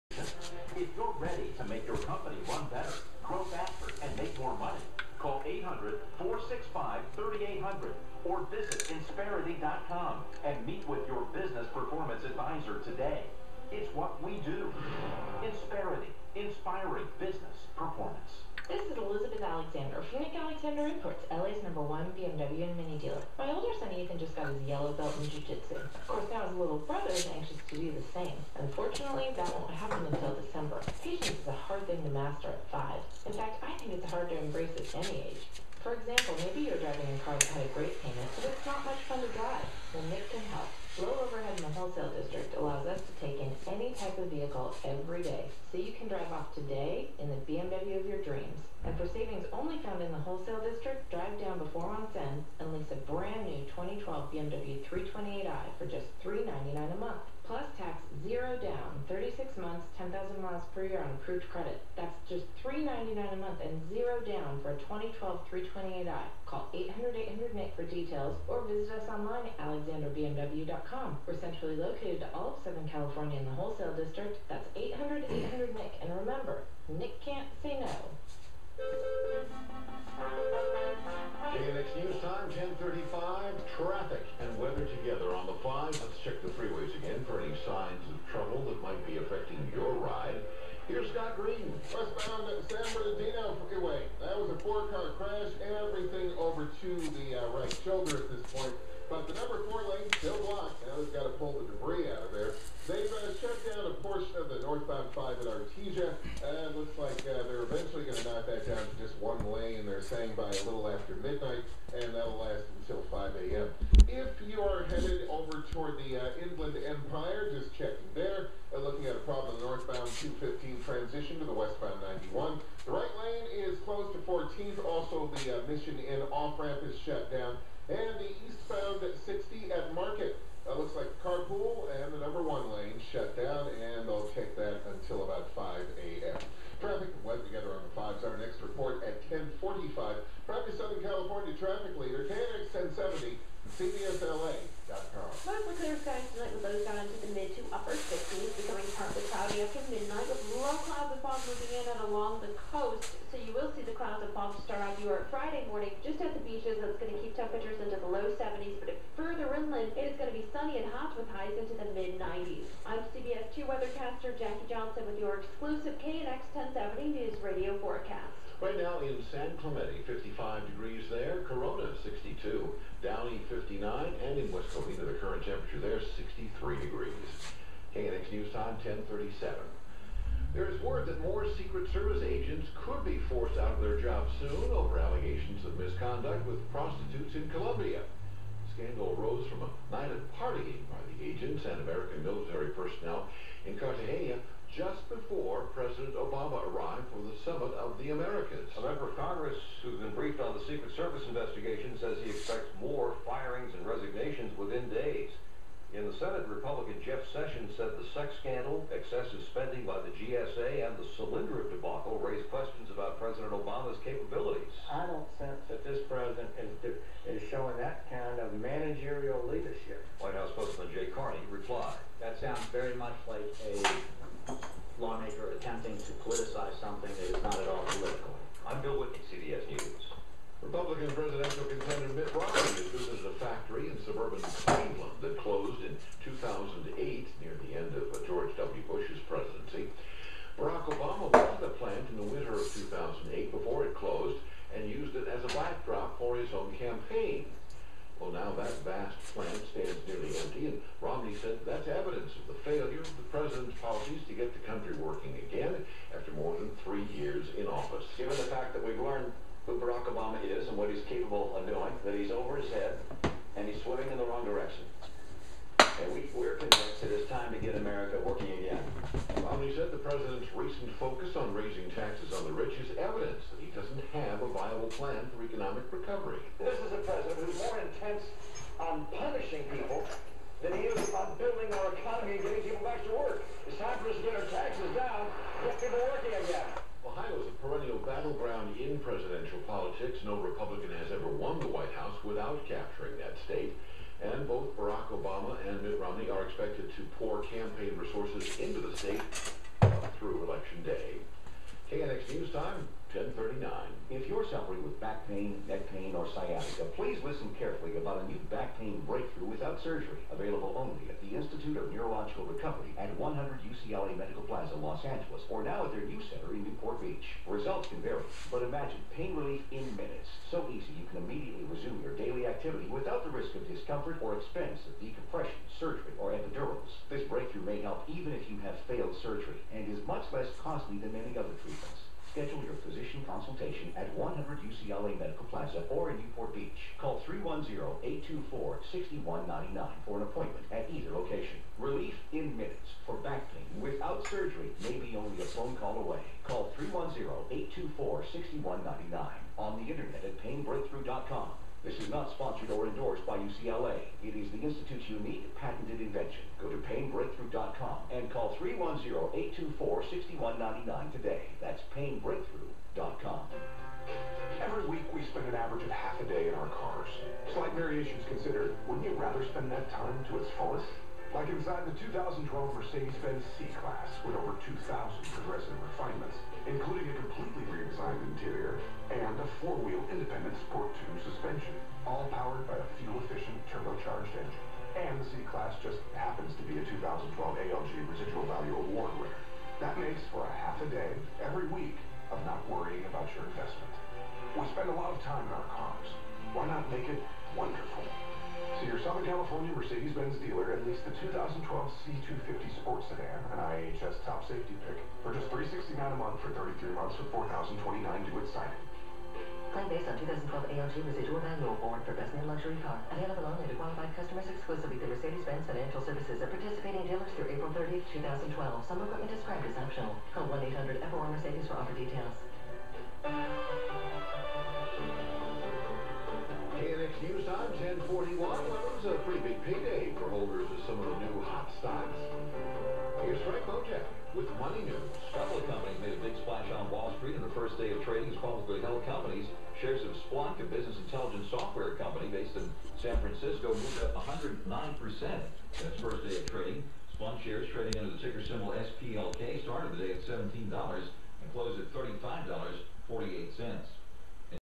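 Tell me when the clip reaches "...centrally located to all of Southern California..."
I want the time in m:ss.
1:11.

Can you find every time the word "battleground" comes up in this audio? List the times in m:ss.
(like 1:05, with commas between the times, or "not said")
4:47.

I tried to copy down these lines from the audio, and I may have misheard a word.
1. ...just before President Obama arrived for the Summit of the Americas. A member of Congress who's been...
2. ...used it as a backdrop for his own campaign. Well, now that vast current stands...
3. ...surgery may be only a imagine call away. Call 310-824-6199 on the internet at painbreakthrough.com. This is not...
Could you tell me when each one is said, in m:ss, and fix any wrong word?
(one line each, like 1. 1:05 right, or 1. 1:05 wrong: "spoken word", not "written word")
1. 3:14 right
2. 4:04 wrong: "plant", not "current"
3. 5:44 wrong: "phone", not "imagine".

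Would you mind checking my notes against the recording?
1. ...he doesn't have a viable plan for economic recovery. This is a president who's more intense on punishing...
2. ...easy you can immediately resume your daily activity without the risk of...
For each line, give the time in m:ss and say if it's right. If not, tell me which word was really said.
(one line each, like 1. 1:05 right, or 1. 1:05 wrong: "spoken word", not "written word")
1. 4:33 right
2. 5:20 right.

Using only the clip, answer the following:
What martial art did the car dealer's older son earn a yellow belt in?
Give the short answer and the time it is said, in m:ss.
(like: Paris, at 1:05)
jiu-jitsu, at 0:25.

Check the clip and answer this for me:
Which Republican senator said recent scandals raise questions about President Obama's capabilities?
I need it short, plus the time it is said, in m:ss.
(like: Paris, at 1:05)
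Jeff Sessions, at 3:27.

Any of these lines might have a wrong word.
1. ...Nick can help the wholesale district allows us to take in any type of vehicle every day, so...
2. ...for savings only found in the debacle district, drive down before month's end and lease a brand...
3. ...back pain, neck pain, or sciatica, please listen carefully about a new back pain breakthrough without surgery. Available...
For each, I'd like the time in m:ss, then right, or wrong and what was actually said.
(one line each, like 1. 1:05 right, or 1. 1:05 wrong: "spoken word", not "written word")
1. 0:40 right
2. 0:48 wrong: "wholesale", not "debacle"
3. 5:05 right.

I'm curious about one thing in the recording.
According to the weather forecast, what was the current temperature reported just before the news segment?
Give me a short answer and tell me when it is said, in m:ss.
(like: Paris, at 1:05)
63 degrees, at 2:55.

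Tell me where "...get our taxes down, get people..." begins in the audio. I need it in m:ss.
4:44.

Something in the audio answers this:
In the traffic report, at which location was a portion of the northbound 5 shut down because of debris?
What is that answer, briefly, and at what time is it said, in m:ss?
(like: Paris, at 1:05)
Artesia, at 1:45.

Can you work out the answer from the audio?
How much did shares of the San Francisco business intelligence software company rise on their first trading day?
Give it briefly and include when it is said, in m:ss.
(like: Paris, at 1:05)
109%, at 7:24.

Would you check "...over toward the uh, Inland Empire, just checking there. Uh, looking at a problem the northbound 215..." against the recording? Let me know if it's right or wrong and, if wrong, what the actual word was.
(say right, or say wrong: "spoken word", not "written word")
right.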